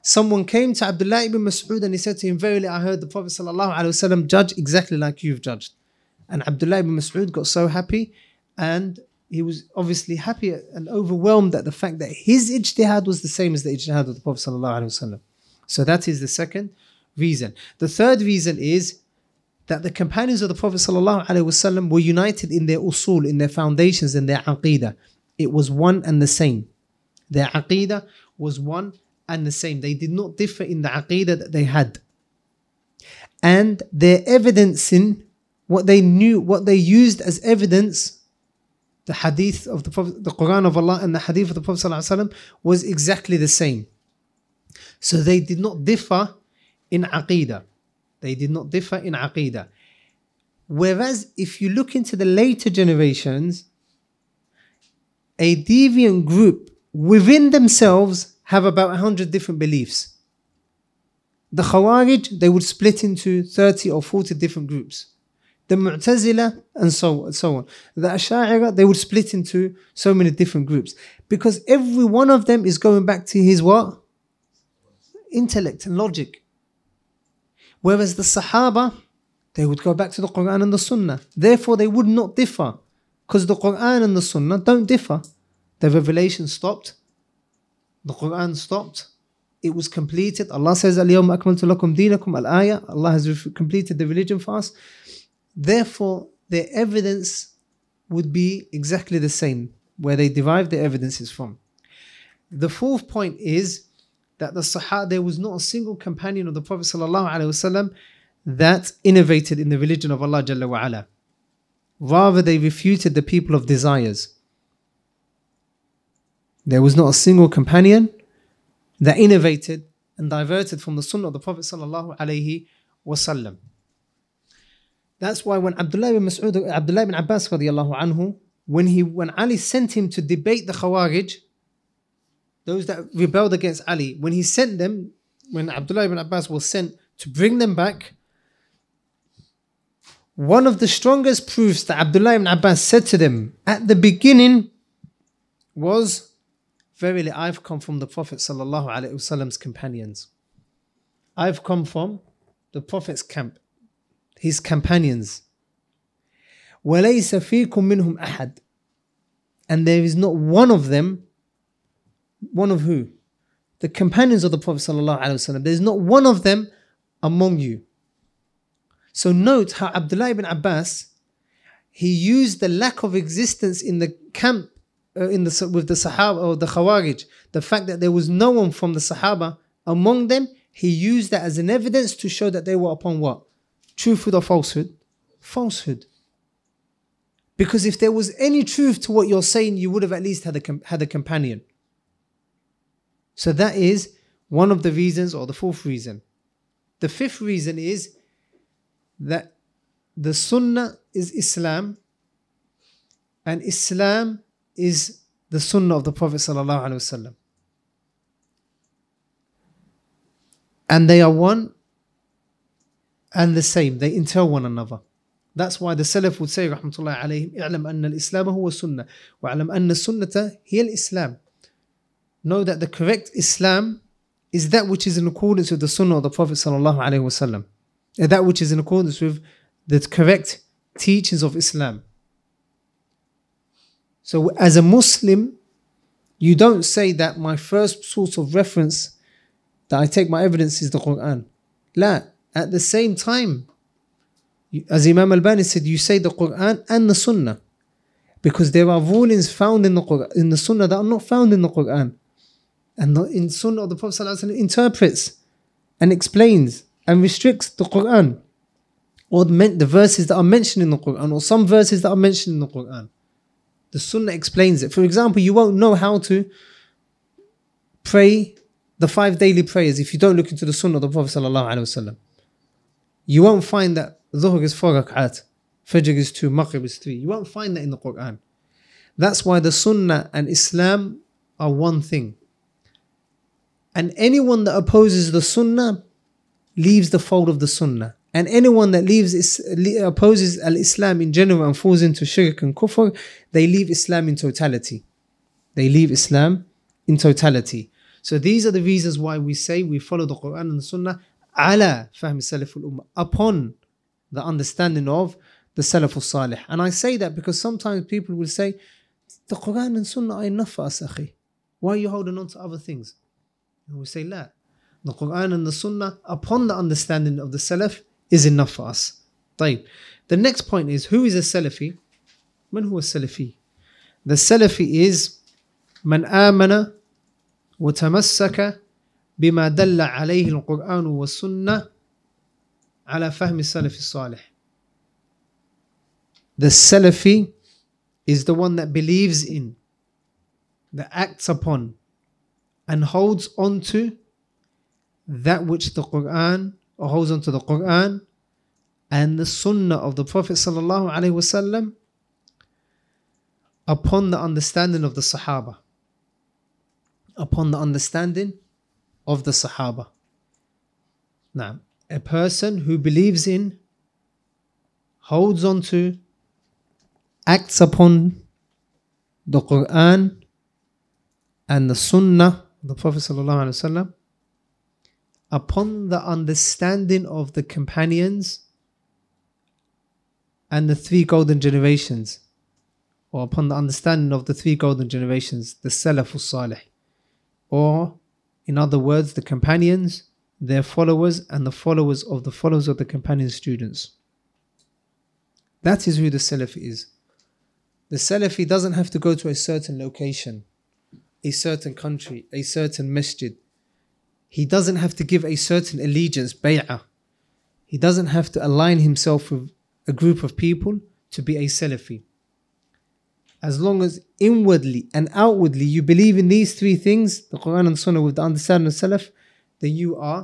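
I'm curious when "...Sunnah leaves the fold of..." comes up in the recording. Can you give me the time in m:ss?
4:45.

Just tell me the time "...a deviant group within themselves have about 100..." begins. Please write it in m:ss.
0:55.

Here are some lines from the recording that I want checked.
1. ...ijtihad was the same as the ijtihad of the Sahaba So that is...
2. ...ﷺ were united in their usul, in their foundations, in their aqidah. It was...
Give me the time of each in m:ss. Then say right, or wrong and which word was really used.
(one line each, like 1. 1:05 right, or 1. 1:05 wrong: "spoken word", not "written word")
1. 0:12 wrong: "Prophet", not "Sahaba"
2. 0:20 right.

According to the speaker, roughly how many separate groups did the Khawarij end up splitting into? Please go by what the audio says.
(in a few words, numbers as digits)
30 or 40.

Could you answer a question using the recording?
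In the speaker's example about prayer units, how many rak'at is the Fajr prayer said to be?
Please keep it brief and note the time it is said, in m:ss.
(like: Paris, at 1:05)
2, at 4:36.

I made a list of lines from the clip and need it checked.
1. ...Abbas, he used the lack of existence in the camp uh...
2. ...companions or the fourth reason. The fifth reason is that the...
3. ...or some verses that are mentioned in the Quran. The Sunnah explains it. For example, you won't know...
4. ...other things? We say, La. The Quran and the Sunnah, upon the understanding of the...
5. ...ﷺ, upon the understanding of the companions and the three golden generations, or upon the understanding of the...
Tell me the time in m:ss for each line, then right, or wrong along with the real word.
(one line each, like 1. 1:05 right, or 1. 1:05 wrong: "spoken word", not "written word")
1. 2:50 right
2. 3:14 wrong: "reasons", not "companions"
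3. 4:21 right
4. 5:12 right
5. 6:13 right.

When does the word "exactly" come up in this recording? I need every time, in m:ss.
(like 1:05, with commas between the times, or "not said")
0:04, 0:42, 1:38.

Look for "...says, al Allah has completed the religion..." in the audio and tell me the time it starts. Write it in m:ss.
1:30.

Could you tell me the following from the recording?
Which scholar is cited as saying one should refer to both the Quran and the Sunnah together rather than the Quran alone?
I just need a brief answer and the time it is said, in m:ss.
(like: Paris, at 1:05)
Imam Albani, at 4:05.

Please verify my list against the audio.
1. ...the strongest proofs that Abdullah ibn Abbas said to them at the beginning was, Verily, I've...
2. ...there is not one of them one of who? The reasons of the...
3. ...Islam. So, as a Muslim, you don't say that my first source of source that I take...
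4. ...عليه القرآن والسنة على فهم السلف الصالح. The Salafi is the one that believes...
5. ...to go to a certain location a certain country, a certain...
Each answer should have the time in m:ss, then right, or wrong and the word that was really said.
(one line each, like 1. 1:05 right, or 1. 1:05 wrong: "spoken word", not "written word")
1. 2:20 right
2. 2:39 wrong: "companions", not "reasons"
3. 3:51 wrong: "reference", not "source"
4. 5:30 right
5. 6:39 right.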